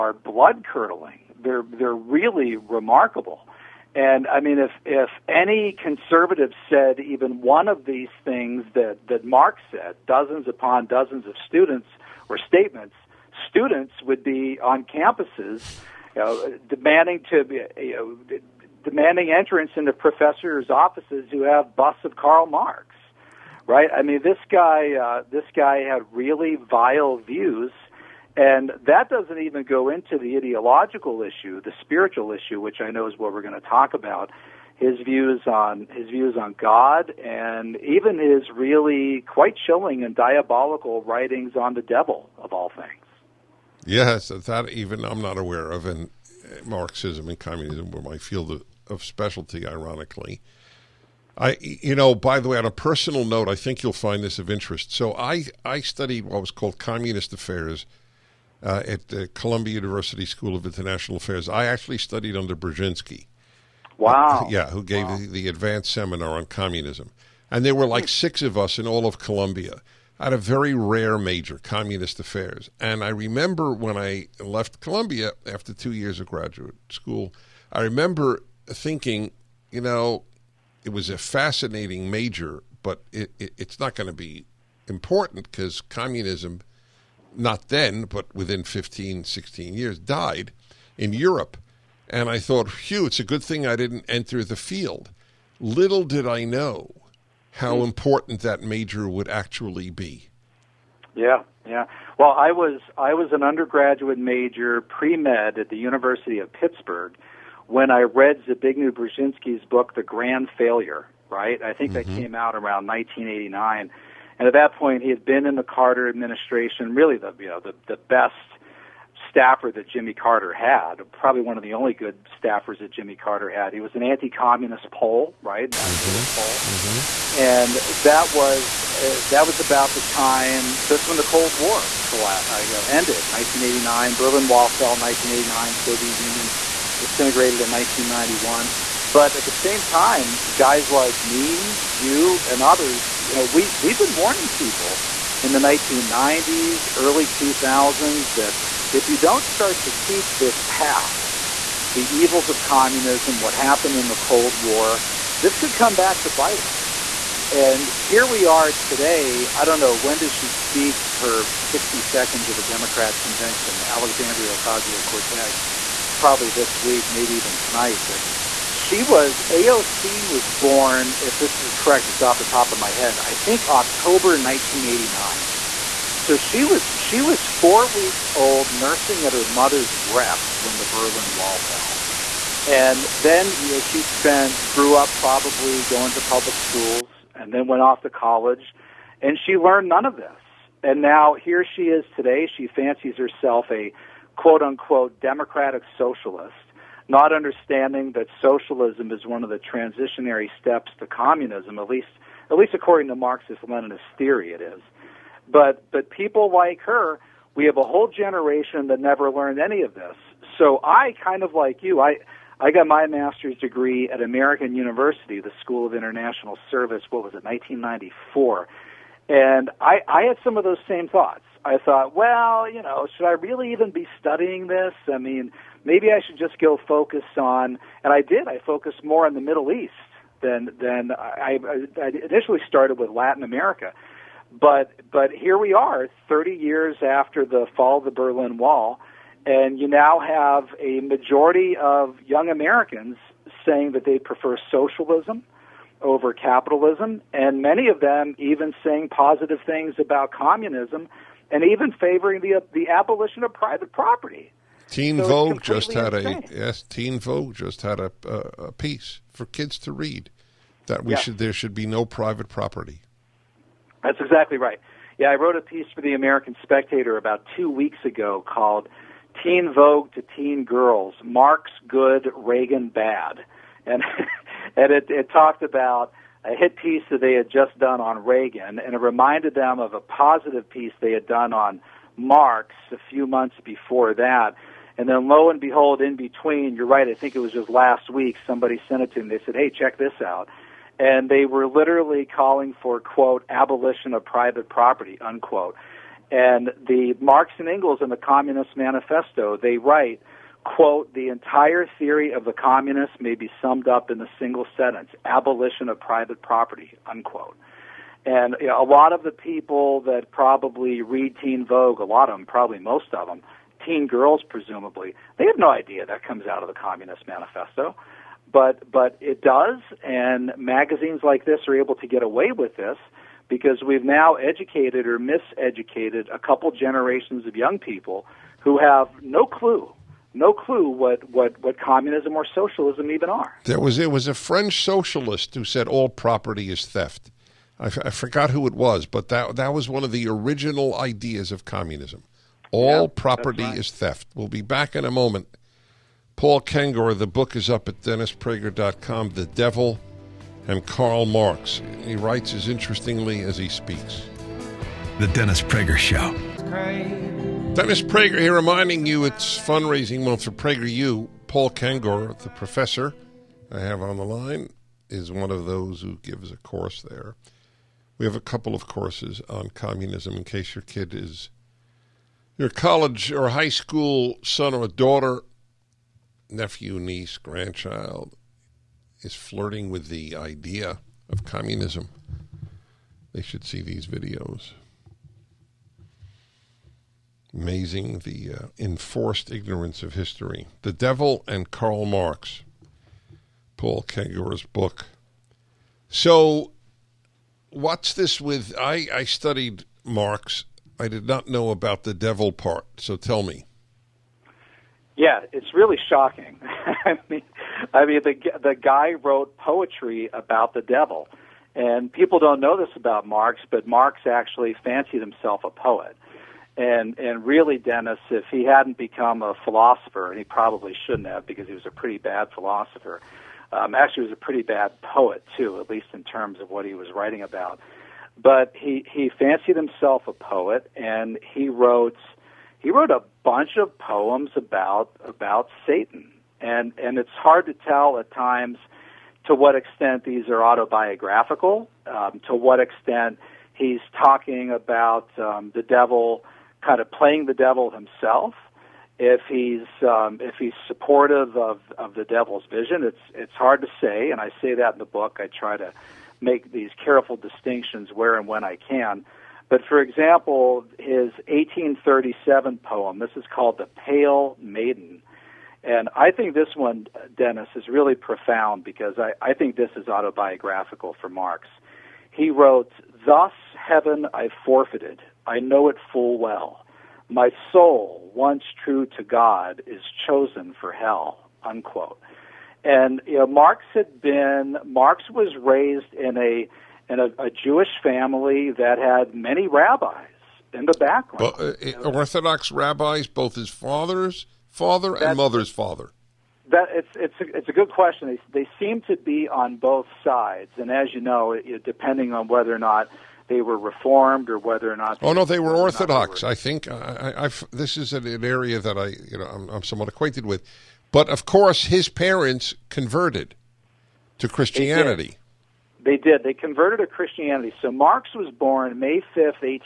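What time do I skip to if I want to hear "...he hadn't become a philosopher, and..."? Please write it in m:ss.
6:58.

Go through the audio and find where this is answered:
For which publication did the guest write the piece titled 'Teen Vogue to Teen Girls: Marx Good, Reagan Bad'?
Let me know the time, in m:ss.
4:26.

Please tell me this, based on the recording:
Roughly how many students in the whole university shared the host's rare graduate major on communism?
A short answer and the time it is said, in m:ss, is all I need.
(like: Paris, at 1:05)
6, at 1:08.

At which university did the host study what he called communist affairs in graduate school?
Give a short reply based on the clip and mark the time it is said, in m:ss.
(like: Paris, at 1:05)
Columbia University, at 0:59.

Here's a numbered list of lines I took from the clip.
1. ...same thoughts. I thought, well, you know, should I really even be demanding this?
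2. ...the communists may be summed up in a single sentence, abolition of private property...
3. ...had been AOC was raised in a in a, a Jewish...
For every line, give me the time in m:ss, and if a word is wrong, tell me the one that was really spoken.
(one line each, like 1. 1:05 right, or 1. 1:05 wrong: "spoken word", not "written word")
1. 3:40 wrong: "studying", not "demanding"
2. 5:02 right
3. 8:03 wrong: "Marx", not "AOC".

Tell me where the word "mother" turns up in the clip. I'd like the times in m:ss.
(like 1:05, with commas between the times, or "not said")
2:59, 8:15.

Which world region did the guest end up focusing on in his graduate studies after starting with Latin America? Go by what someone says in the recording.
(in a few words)
The Middle East.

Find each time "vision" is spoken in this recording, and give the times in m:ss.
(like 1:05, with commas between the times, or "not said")
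7:32.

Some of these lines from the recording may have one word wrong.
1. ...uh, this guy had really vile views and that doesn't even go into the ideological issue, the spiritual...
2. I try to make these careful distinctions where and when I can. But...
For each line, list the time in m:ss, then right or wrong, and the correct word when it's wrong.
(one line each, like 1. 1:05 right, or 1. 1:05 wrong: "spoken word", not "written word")
1. 0:24 right
2. 7:35 right.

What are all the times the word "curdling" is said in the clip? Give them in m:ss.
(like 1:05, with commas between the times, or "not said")
0:00.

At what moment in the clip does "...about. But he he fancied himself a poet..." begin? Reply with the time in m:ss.
7:07.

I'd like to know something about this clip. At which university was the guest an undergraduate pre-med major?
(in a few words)
University of Pittsburgh.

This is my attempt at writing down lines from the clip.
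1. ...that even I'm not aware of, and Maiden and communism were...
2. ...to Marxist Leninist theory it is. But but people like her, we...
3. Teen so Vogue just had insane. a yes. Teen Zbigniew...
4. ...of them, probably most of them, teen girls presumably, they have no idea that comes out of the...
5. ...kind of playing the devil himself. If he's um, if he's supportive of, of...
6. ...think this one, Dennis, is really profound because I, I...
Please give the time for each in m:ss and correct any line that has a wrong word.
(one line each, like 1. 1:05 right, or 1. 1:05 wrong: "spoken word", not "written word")
1. 0:44 wrong: "Marxism", not "Maiden"
2. 3:23 right
3. 4:14 wrong: "Vogue", not "Zbigniew"
4. 5:12 right
5. 7:26 right
6. 7:46 right.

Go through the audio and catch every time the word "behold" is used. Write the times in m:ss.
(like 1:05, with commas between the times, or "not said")
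4:45.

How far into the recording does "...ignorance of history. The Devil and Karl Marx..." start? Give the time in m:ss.
6:29.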